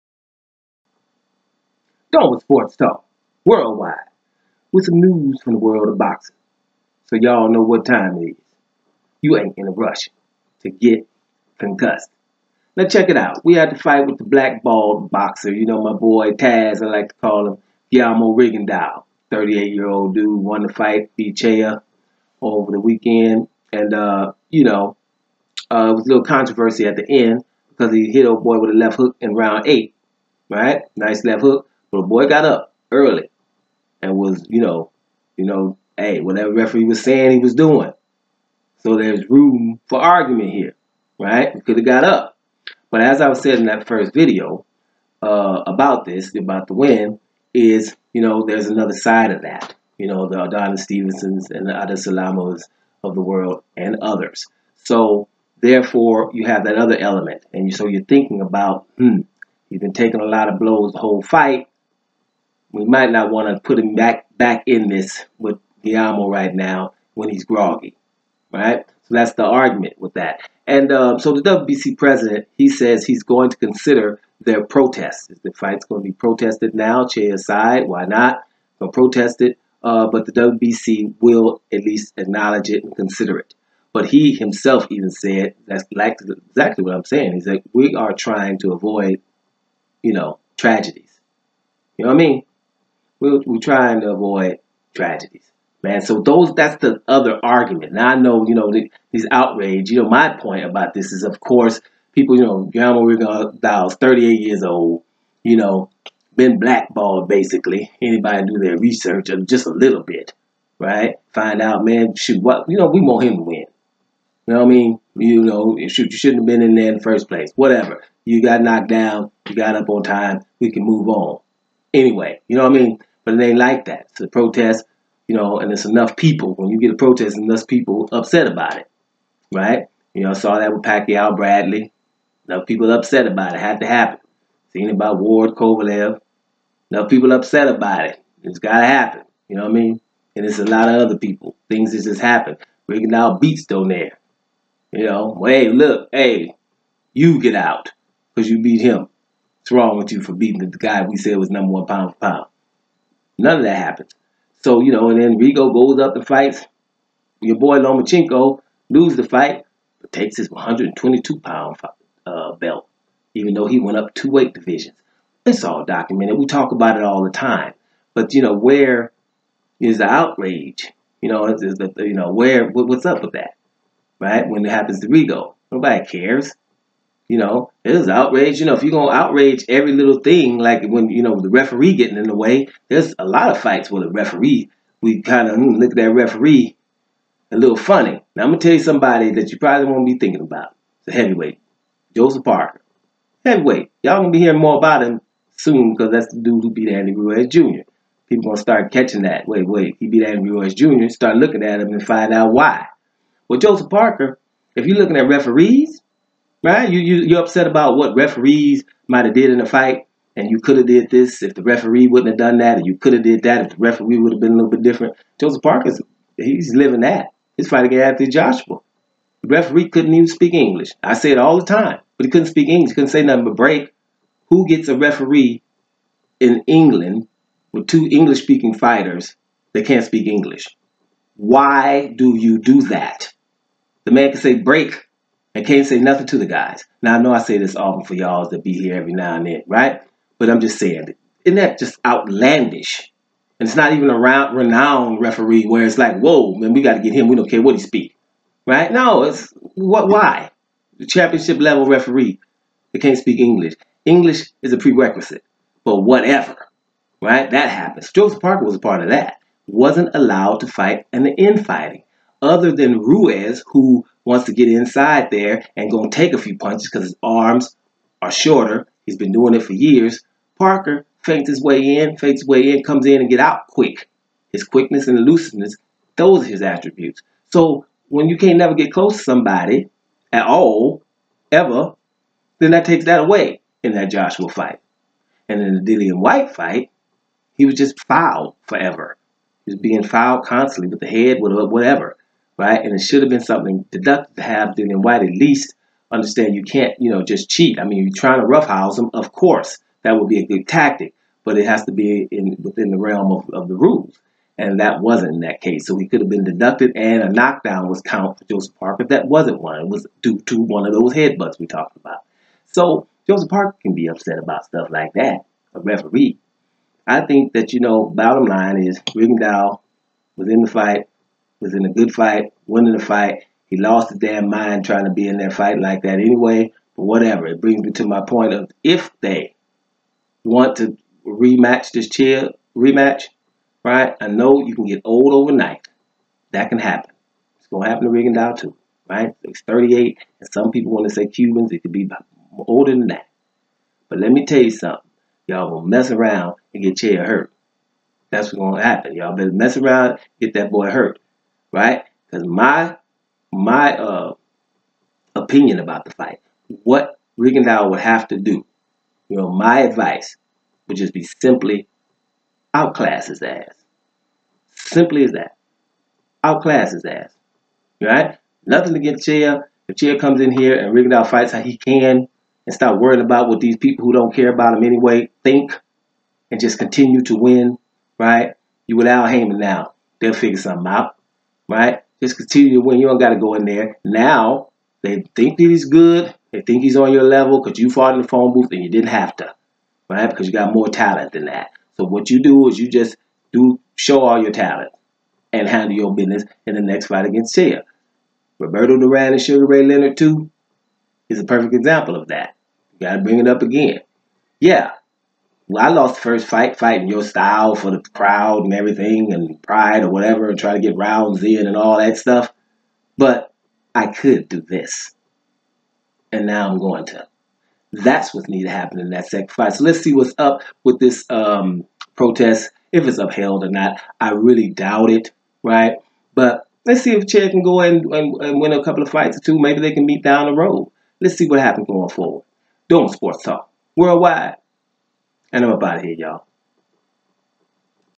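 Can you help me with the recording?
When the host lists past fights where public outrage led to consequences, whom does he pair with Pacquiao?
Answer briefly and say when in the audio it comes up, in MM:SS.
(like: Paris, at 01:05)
Bradley, at 02:11.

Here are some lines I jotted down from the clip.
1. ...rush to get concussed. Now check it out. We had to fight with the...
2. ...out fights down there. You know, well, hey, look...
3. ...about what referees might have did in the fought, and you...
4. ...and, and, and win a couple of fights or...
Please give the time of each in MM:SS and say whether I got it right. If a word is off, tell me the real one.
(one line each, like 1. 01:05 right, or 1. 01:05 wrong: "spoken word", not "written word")
1. 00:09 right
2. 02:23 wrong: "beats", not "fights"
3. 03:27 wrong: "fight", not "fought"
4. 07:07 right.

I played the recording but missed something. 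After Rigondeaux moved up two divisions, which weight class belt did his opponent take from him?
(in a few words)
122 pounds.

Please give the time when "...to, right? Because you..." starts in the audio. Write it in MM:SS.
06:29.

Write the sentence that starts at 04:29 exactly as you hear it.
He's been doing it for years.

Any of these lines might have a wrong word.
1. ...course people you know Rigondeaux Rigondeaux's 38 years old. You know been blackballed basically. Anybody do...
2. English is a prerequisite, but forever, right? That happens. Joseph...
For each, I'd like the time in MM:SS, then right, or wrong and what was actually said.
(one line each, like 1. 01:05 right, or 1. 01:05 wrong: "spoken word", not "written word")
1. 01:41 wrong: "Guillermo", not "Rigondeaux"
2. 04:14 wrong: "whatever", not "forever".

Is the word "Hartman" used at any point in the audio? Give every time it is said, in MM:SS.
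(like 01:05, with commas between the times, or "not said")
not said.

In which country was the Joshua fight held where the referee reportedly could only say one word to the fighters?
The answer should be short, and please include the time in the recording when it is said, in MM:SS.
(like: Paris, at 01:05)
England, at 03:46.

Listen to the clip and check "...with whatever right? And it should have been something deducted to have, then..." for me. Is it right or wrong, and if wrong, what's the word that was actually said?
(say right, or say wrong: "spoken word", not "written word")
right.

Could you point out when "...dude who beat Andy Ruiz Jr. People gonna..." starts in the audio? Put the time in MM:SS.
03:16.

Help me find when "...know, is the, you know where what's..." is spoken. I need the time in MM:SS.
02:51.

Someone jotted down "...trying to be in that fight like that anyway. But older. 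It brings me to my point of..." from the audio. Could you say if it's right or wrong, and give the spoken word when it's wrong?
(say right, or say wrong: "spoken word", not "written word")
wrong: "whatever", not "older".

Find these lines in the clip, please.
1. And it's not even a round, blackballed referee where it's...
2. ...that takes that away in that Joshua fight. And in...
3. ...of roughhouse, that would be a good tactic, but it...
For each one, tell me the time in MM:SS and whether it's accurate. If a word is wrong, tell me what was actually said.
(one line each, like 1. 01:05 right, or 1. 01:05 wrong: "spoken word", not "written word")
1. 04:03 wrong: "renowned", not "blackballed"
2. 04:42 right
3. 04:59 wrong: "course", not "roughhouse".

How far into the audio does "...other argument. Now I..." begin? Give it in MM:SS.
01:37.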